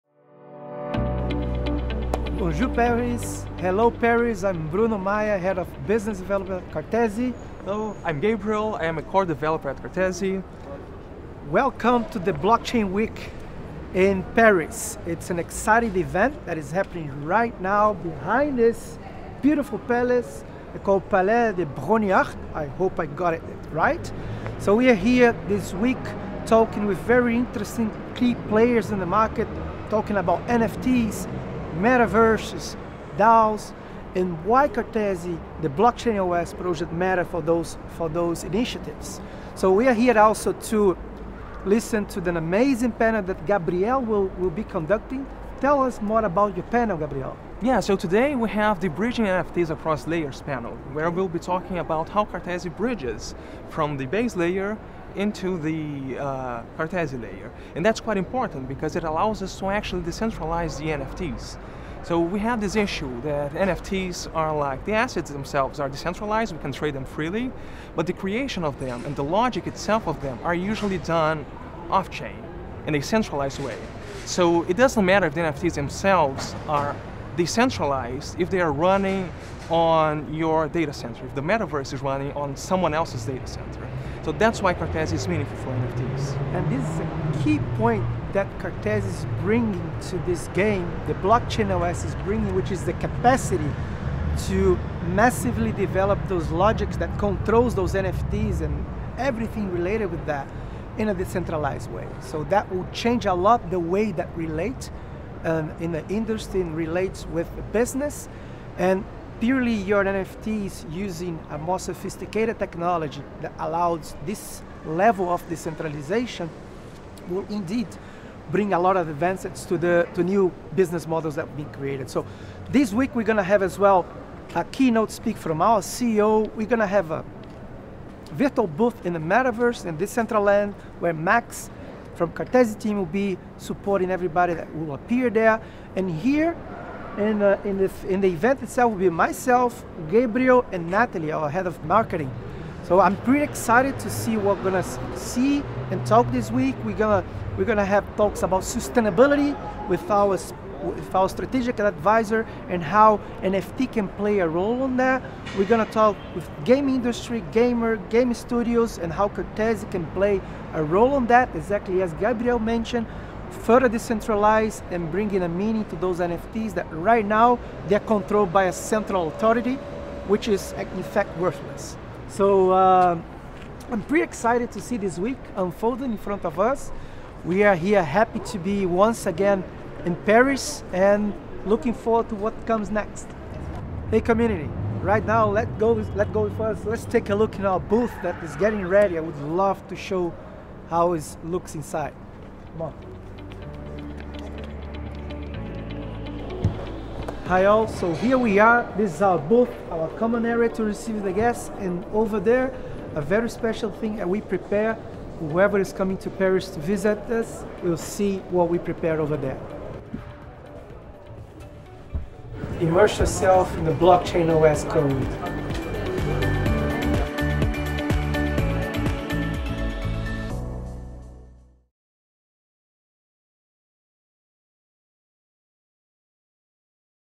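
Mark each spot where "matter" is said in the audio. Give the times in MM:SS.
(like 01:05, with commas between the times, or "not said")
00:36, 01:15.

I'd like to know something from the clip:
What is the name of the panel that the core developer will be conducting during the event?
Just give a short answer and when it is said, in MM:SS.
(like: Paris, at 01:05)
Bridging NFTs Across Layers, at 00:48.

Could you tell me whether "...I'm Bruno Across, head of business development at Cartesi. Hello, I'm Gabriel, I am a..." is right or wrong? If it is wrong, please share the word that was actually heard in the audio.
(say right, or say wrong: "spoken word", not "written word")
wrong: "Maia", not "Across".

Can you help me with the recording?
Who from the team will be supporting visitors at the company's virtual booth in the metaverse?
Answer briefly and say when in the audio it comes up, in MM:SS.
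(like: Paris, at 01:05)
Max, at 02:11.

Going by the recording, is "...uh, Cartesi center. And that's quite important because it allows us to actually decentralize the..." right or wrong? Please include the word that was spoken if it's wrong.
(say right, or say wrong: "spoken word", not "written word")
wrong: "layer", not "center".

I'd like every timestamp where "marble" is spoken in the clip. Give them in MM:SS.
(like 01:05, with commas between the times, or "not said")
not said.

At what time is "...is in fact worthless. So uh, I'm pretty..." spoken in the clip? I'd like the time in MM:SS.
02:50.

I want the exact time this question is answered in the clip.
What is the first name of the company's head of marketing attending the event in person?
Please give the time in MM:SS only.
02:20.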